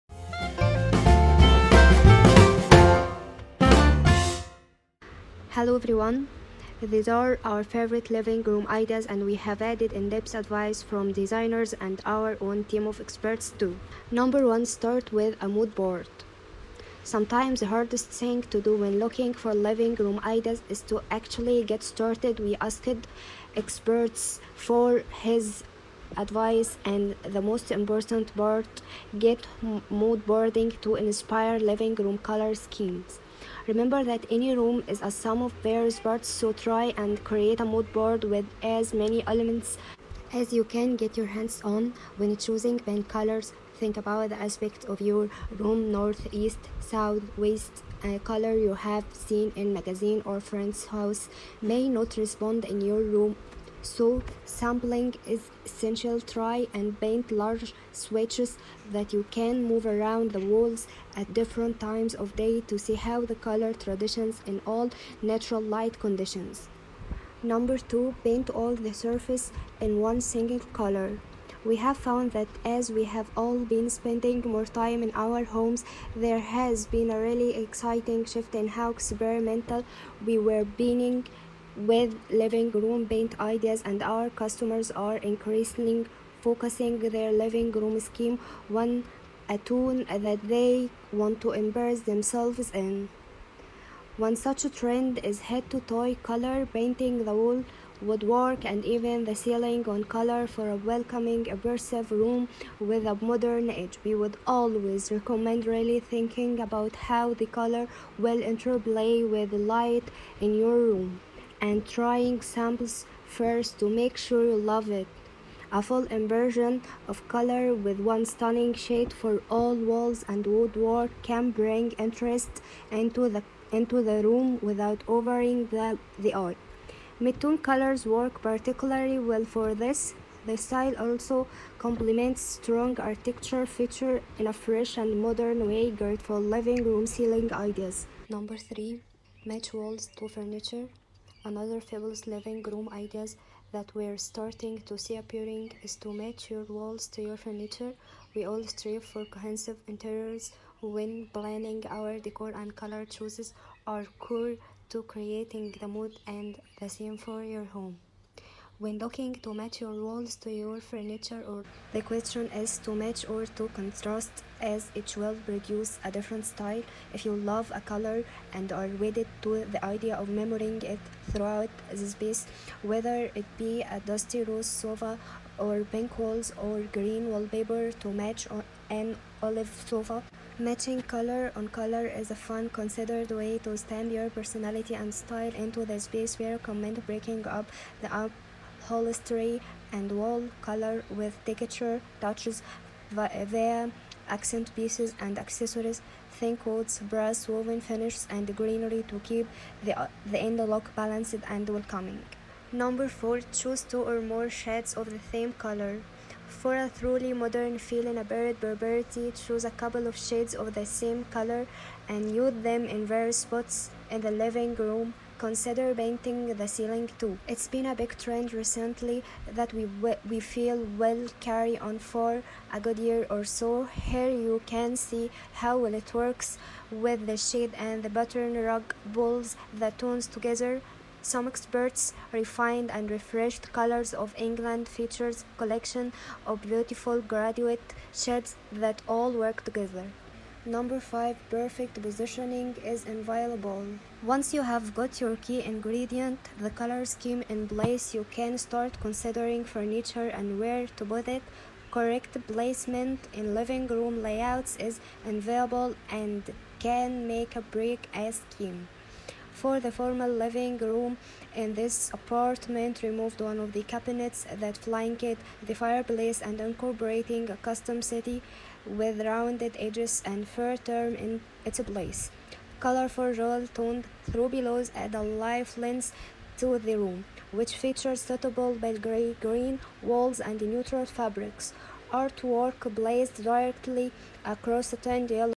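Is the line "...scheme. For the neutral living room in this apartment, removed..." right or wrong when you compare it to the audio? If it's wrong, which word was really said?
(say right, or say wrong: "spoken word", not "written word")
wrong: "formal", not "neutral".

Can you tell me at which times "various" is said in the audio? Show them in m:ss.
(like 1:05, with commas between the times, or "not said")
0:35, 3:33.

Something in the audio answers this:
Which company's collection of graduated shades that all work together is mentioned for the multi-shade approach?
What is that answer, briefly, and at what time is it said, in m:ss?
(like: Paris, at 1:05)
Colors of England, at 3:53.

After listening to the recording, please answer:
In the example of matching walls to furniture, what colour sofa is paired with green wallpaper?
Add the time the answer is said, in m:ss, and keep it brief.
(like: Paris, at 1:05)
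olive, at 2:59.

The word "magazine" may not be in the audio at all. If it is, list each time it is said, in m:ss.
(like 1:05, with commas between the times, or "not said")
0:49.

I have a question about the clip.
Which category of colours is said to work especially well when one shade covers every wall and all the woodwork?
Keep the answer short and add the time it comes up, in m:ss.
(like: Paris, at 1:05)
Midtone colors, at 2:07.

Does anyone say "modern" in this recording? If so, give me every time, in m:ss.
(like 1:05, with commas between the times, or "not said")
1:43, 2:15, 3:27.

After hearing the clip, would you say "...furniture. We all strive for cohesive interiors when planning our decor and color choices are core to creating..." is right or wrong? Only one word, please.
right.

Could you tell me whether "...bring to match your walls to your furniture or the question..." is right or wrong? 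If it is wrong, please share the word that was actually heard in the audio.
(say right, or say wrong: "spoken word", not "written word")
wrong: "looking", not "bring".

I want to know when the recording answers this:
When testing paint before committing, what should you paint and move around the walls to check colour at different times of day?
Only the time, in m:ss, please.
0:57.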